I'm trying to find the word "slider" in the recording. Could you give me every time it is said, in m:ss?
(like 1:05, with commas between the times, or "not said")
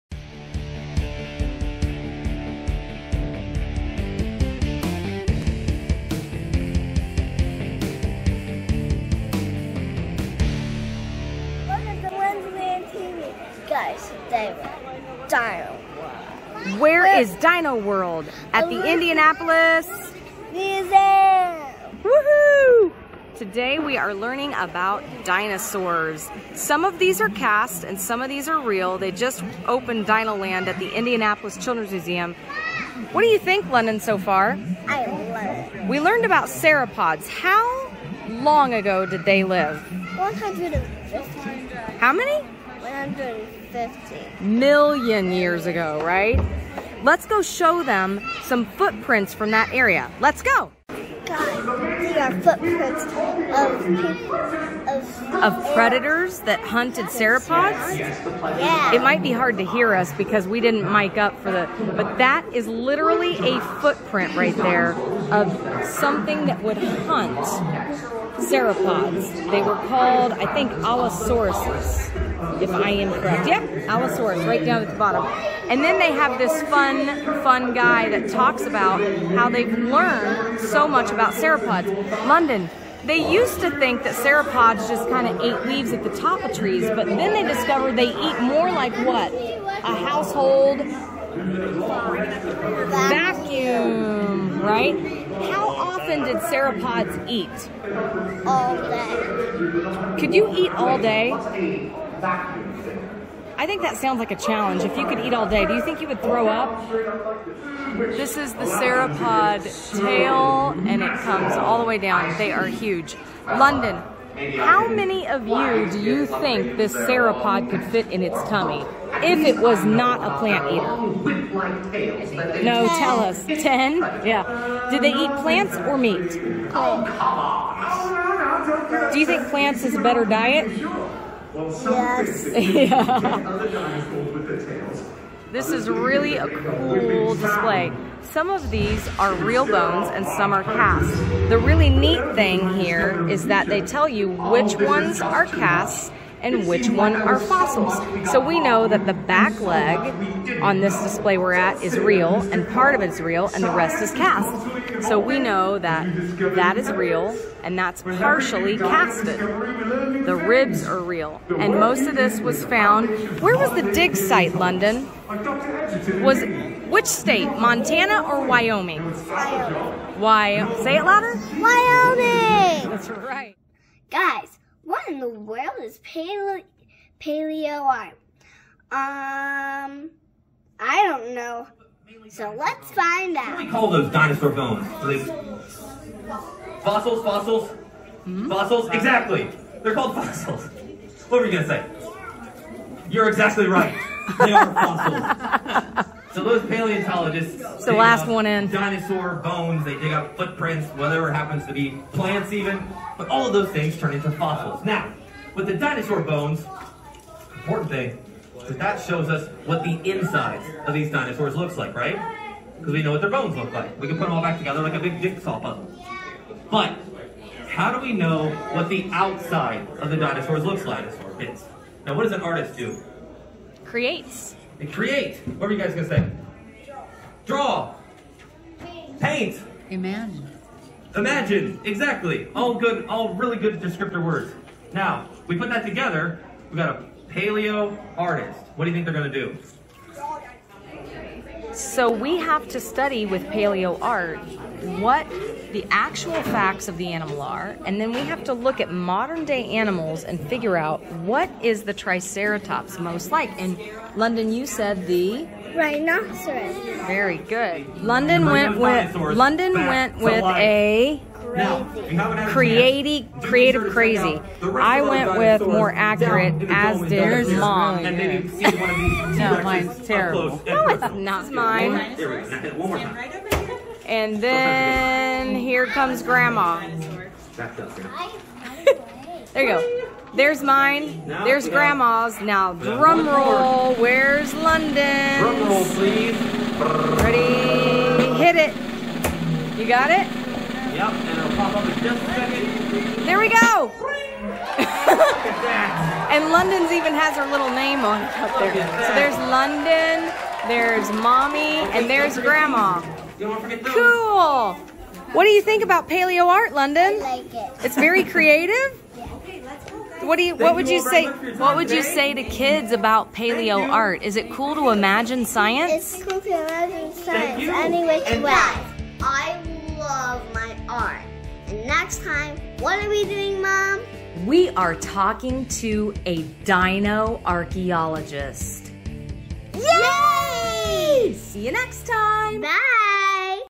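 not said.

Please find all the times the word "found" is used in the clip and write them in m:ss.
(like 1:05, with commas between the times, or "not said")
2:42.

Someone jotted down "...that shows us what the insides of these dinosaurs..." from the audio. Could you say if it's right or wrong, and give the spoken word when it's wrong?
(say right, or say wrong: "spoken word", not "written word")
right.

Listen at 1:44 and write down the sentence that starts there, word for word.
If you could eat all day, do you think you would throw up?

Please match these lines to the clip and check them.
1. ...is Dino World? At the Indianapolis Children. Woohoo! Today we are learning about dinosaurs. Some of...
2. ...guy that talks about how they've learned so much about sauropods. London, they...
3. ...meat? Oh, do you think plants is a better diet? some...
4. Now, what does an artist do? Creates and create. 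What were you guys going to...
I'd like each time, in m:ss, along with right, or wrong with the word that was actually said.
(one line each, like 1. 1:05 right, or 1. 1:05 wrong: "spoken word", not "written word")
1. 0:17 wrong: "Museum", not "Children"
2. 1:17 right
3. 2:05 right
4. 3:42 right.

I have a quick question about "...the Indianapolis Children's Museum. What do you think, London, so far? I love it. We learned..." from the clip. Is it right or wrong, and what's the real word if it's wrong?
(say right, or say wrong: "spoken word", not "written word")
right.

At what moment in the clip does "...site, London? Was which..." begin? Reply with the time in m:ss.
2:44.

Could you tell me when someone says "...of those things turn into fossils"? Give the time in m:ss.
3:23.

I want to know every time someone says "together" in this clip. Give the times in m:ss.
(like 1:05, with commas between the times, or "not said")
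3:34, 3:55.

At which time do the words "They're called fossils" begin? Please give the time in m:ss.
3:09.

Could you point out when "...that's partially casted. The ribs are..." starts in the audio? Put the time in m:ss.
2:37.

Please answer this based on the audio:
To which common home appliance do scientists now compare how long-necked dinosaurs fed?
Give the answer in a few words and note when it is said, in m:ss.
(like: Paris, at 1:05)
A household vacuum, at 1:29.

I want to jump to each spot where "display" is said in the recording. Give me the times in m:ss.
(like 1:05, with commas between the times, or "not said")
2:17, 2:31.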